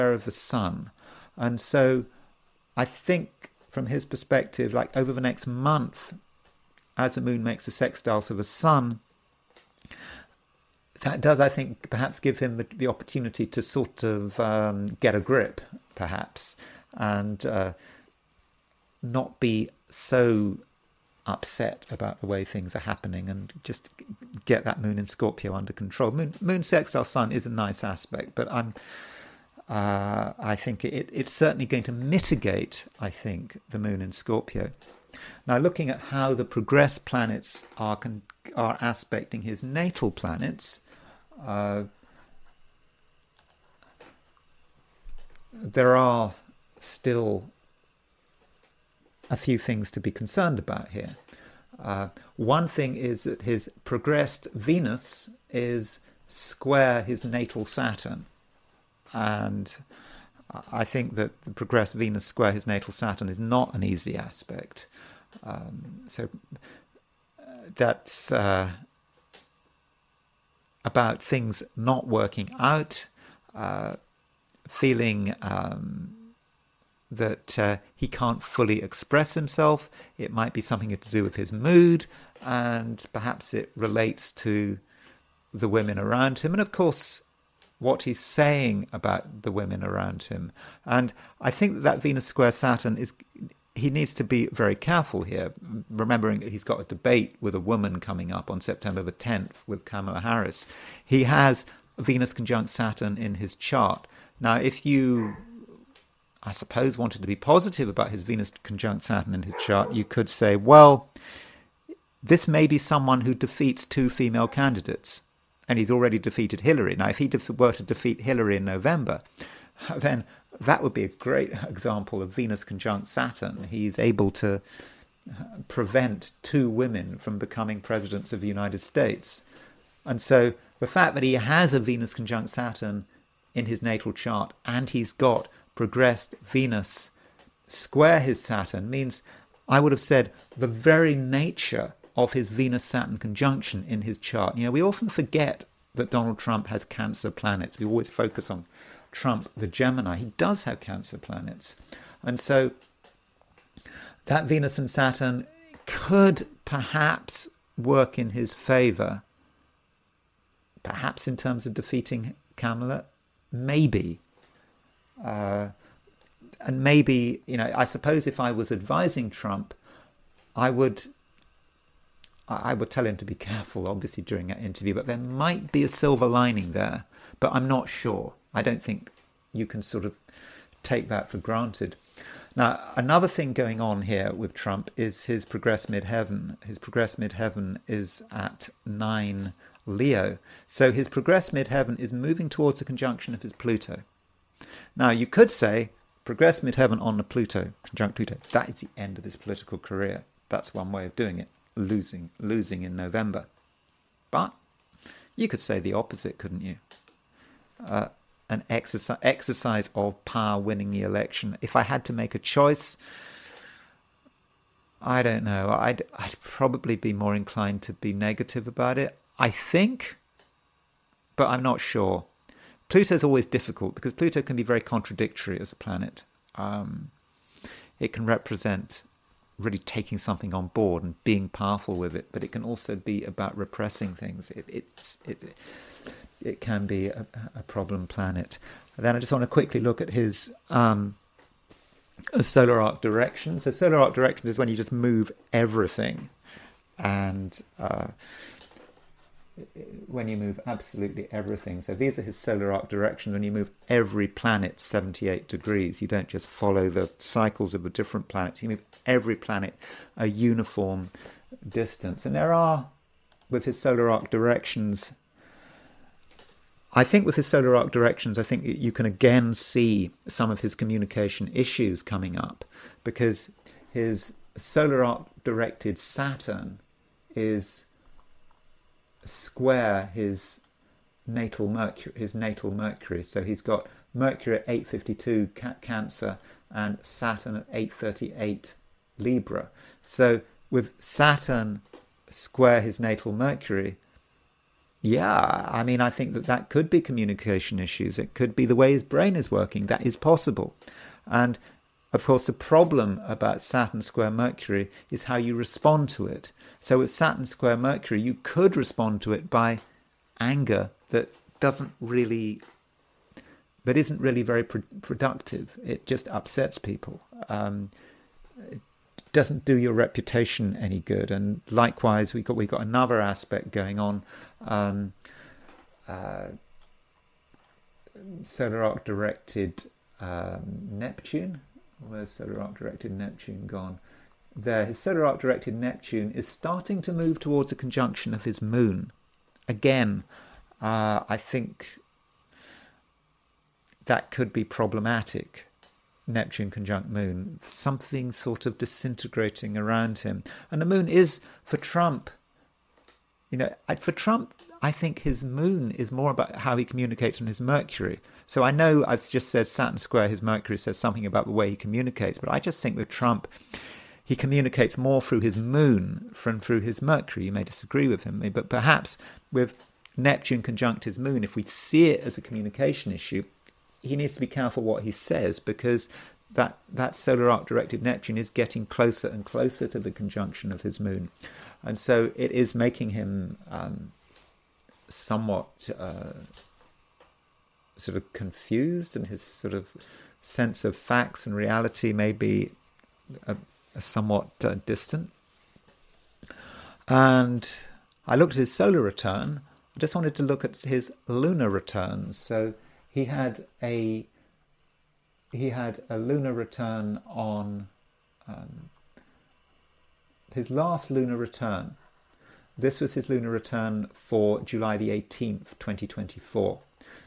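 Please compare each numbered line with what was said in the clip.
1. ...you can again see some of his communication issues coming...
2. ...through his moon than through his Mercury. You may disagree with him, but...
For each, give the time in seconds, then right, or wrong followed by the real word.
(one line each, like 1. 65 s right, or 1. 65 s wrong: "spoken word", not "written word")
1. 268 s right
2. 365 s right.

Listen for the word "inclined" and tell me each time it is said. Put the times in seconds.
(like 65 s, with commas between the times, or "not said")
217 s.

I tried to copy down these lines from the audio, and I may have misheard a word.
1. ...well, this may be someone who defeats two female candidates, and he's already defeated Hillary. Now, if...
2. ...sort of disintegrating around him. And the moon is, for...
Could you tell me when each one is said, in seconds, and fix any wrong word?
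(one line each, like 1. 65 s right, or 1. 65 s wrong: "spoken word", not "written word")
1. 110 s right
2. 348 s right.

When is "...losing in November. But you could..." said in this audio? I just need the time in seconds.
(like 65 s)
202 s.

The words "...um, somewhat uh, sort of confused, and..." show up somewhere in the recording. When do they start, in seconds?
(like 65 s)
383 s.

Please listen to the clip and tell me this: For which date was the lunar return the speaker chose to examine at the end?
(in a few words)
July 18, 2024.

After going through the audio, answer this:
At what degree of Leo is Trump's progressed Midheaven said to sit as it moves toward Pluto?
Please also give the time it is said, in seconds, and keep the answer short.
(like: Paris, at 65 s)
9 Leo, at 188 s.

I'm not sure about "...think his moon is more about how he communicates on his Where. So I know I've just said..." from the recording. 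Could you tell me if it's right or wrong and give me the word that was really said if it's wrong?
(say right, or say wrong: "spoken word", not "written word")
wrong: "Mercury", not "Where".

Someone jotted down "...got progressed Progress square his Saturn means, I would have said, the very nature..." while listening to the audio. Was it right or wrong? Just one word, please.
wrong.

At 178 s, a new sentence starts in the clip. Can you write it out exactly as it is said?
I don't think you can sort of take that for granted.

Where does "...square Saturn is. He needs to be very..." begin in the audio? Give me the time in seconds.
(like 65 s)
92 s.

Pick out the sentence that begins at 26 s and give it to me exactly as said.
Moon, moon sextile sun is a nice aspect, but I'm.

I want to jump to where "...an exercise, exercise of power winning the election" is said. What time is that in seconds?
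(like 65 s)
208 s.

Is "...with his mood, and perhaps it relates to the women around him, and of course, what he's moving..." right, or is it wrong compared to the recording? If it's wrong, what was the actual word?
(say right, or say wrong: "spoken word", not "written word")
wrong: "saying", not "moving".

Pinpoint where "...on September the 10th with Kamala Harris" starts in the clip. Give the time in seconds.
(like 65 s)
98 s.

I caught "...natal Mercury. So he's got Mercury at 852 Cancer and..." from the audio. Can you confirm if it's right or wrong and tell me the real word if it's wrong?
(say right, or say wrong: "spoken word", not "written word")
right.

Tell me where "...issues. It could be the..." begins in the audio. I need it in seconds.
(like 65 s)
297 s.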